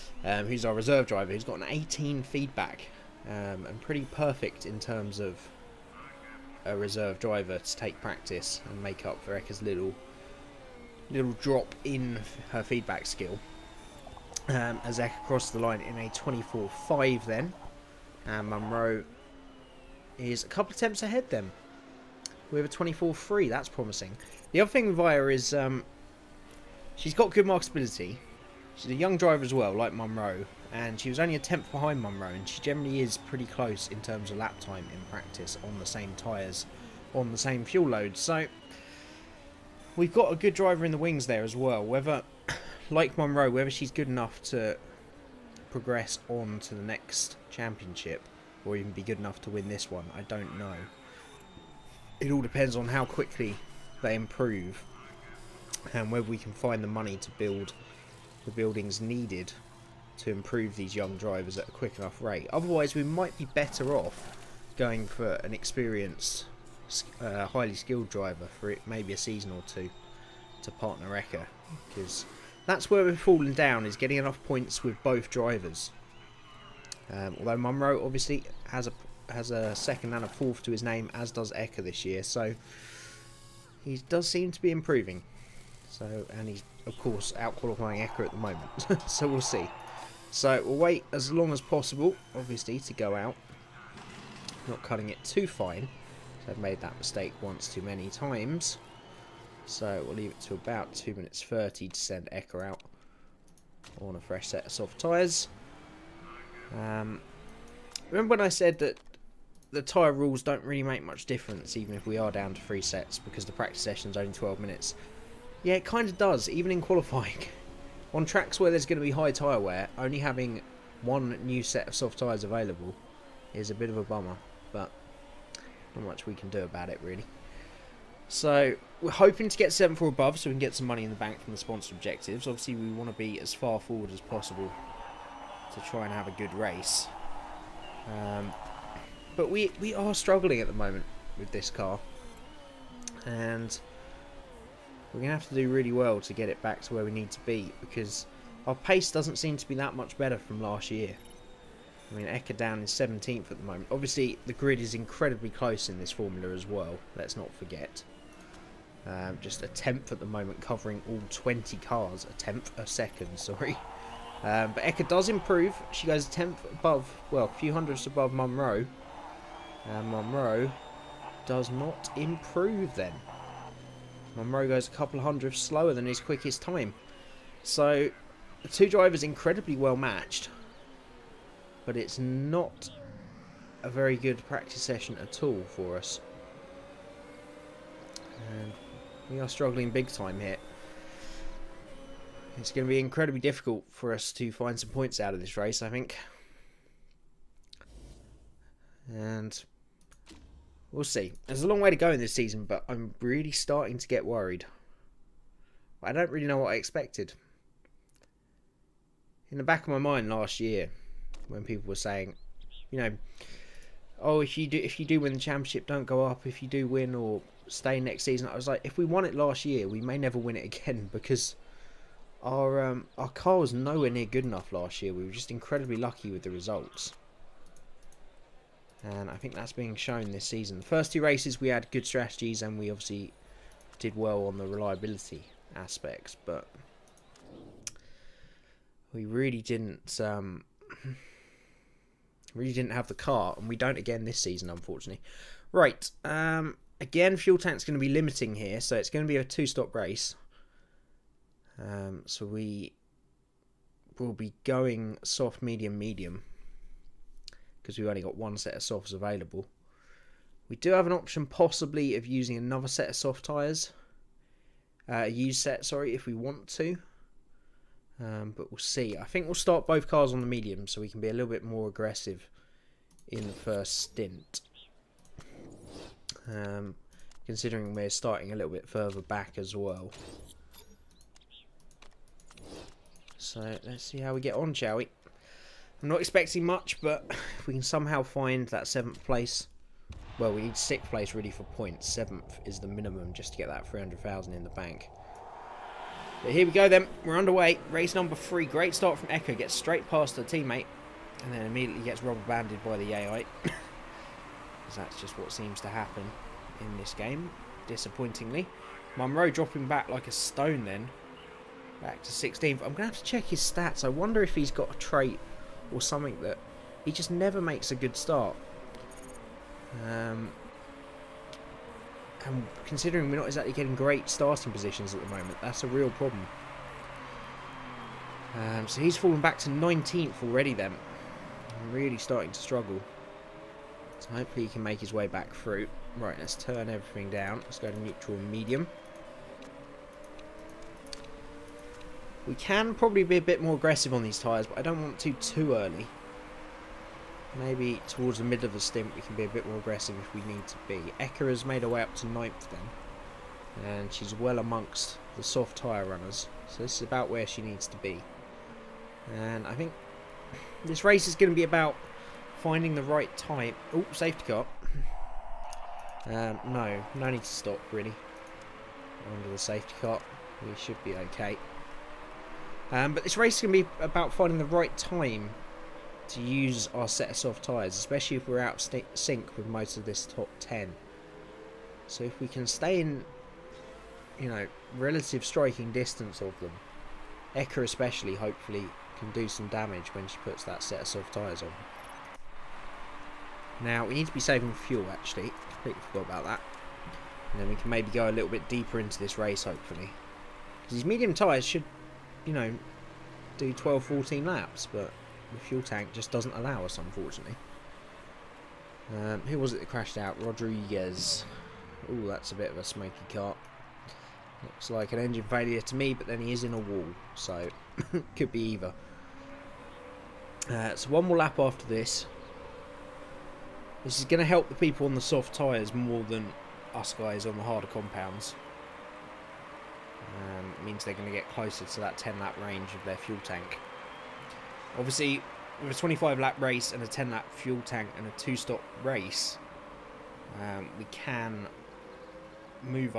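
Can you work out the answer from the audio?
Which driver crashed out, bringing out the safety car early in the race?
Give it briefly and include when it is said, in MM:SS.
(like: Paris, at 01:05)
Rodriguez, at 06:50.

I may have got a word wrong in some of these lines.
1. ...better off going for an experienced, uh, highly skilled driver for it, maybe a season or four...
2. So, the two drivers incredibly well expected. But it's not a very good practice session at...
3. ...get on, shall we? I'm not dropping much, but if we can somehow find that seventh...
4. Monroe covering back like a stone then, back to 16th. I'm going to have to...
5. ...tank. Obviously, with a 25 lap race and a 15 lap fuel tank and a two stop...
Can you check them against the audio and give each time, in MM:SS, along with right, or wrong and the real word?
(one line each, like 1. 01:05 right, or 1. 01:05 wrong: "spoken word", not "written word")
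1. 01:03 wrong: "two", not "four"
2. 02:57 wrong: "matched", not "expected"
3. 04:44 wrong: "expecting", not "dropping"
4. 05:09 wrong: "dropping", not "covering"
5. 07:13 wrong: "10", not "15".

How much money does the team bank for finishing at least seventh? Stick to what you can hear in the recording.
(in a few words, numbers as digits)
300,000.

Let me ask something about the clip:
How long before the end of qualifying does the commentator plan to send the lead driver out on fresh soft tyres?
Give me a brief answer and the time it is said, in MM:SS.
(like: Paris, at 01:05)
2 minutes 30, at 01:40.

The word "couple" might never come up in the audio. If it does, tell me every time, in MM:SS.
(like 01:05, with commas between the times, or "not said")
00:20, 02:54.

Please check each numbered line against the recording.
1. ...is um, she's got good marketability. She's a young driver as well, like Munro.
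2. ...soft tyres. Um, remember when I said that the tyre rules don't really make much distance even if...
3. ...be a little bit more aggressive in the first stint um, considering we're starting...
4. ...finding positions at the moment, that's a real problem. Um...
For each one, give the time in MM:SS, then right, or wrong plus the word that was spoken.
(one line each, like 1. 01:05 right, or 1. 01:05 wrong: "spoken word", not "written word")
1. 00:25 right
2. 01:44 wrong: "difference", not "distance"
3. 04:31 right
4. 05:24 wrong: "starting", not "finding".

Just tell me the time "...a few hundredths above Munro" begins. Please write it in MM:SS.
02:47.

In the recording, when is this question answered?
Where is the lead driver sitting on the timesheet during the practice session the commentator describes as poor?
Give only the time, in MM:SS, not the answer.
02:32.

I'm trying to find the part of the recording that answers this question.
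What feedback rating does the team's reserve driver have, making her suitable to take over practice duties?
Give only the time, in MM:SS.
00:01.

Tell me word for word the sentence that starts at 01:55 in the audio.
Yeah, it kind of does, even in qualifying.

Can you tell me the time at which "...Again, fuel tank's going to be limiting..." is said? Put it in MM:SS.
04:07.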